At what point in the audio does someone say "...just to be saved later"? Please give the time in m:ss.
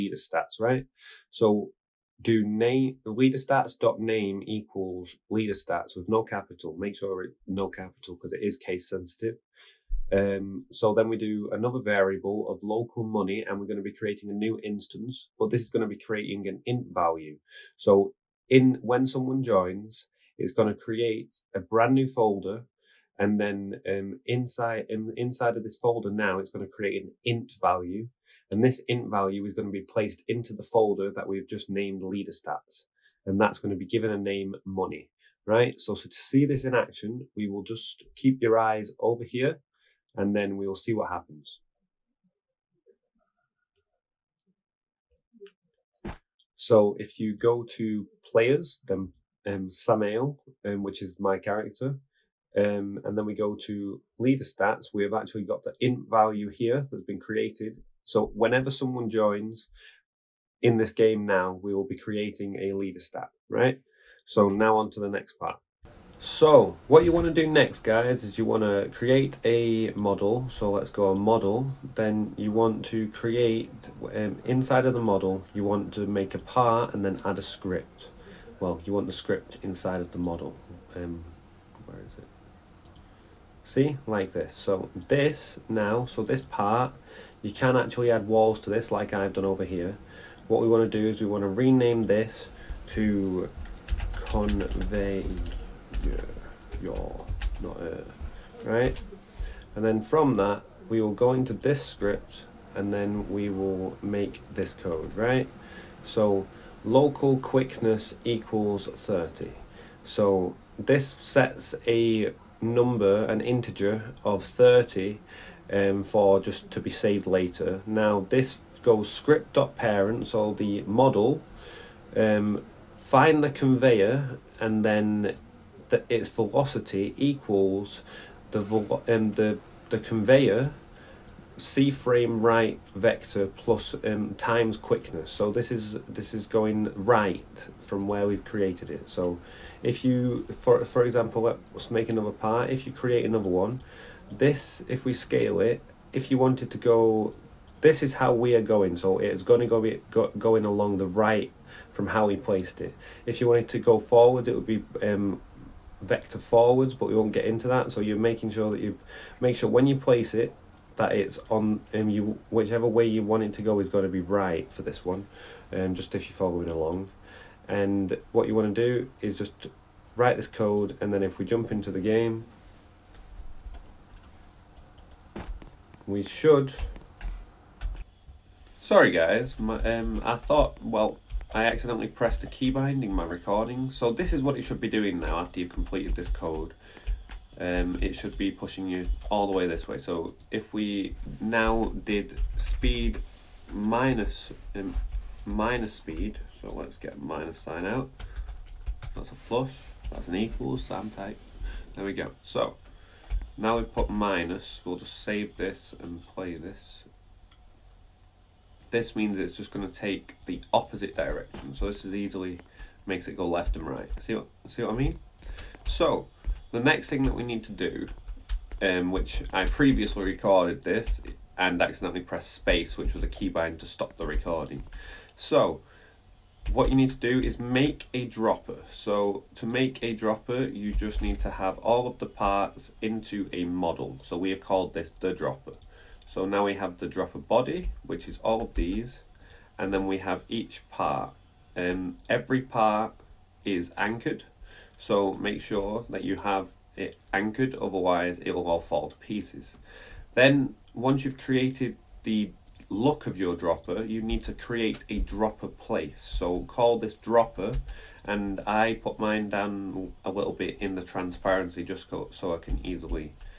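1:56.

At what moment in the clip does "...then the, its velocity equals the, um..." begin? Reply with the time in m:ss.
2:04.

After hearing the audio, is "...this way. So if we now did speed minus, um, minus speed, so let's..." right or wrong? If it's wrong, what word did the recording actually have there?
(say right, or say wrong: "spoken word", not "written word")
right.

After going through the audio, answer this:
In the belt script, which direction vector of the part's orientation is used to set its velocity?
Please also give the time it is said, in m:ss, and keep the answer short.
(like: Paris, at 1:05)
right vector, at 2:12.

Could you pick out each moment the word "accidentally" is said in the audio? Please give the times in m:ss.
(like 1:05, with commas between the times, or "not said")
3:01, 3:41.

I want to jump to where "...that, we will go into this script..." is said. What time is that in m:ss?
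1:40.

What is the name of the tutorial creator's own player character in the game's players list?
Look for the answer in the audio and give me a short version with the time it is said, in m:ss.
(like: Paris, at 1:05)
Samael, at 0:49.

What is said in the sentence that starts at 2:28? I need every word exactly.
So it's going to go, be, go going along the right from how we placed it.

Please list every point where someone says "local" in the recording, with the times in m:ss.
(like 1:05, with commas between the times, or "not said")
0:12, 1:46.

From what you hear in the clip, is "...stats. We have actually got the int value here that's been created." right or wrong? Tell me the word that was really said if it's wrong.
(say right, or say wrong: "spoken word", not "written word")
right.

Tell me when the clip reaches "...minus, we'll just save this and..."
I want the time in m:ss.
3:24.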